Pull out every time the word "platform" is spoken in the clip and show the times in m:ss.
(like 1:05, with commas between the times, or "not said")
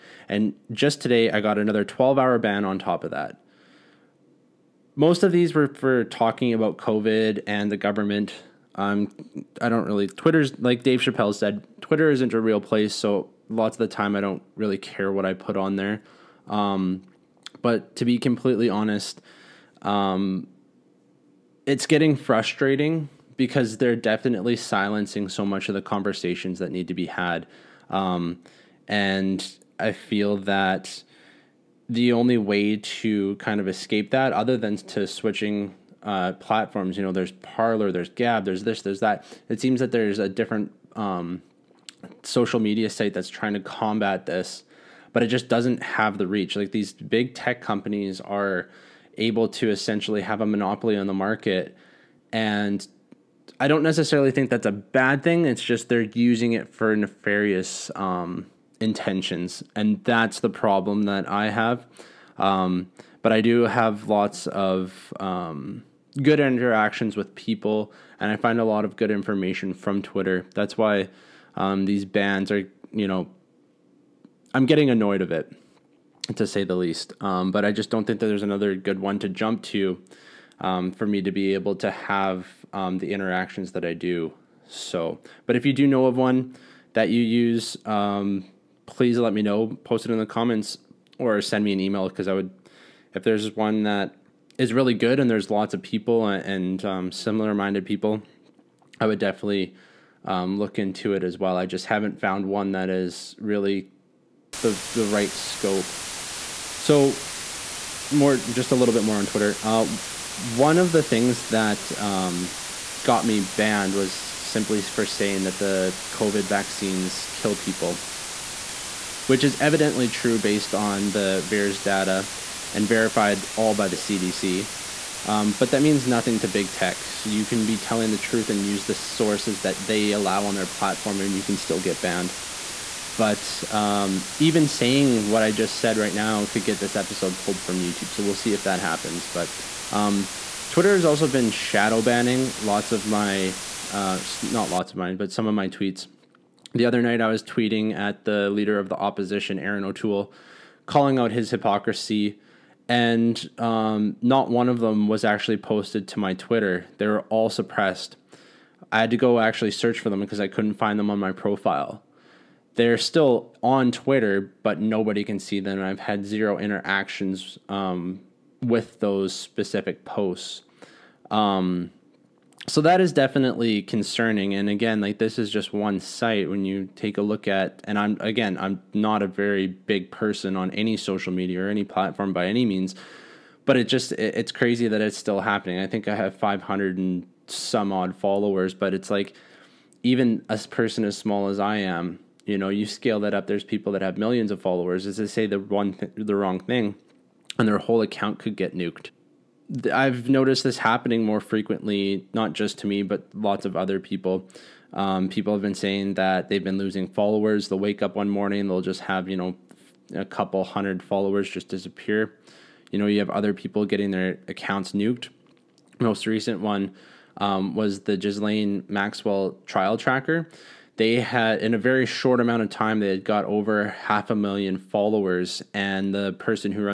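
0:36, 2:10, 3:01.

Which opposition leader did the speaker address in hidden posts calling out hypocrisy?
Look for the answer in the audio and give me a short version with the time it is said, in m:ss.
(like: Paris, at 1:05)
Erin O'Toole, at 2:29.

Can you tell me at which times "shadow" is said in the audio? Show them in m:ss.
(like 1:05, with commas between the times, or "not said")
2:21.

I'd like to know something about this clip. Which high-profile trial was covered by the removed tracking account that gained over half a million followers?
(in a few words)
Ghislaine Maxwell trial.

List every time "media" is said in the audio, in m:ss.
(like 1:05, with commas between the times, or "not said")
0:42, 3:01.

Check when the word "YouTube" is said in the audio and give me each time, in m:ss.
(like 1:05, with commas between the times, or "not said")
2:17.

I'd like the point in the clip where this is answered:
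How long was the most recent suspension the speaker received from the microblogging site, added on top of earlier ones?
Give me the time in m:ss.
0:01.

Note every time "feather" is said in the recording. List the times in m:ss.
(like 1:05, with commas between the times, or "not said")
not said.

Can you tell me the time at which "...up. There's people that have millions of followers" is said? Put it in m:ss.
3:13.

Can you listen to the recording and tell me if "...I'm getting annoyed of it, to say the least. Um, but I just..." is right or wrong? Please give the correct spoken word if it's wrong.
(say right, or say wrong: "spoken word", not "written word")
right.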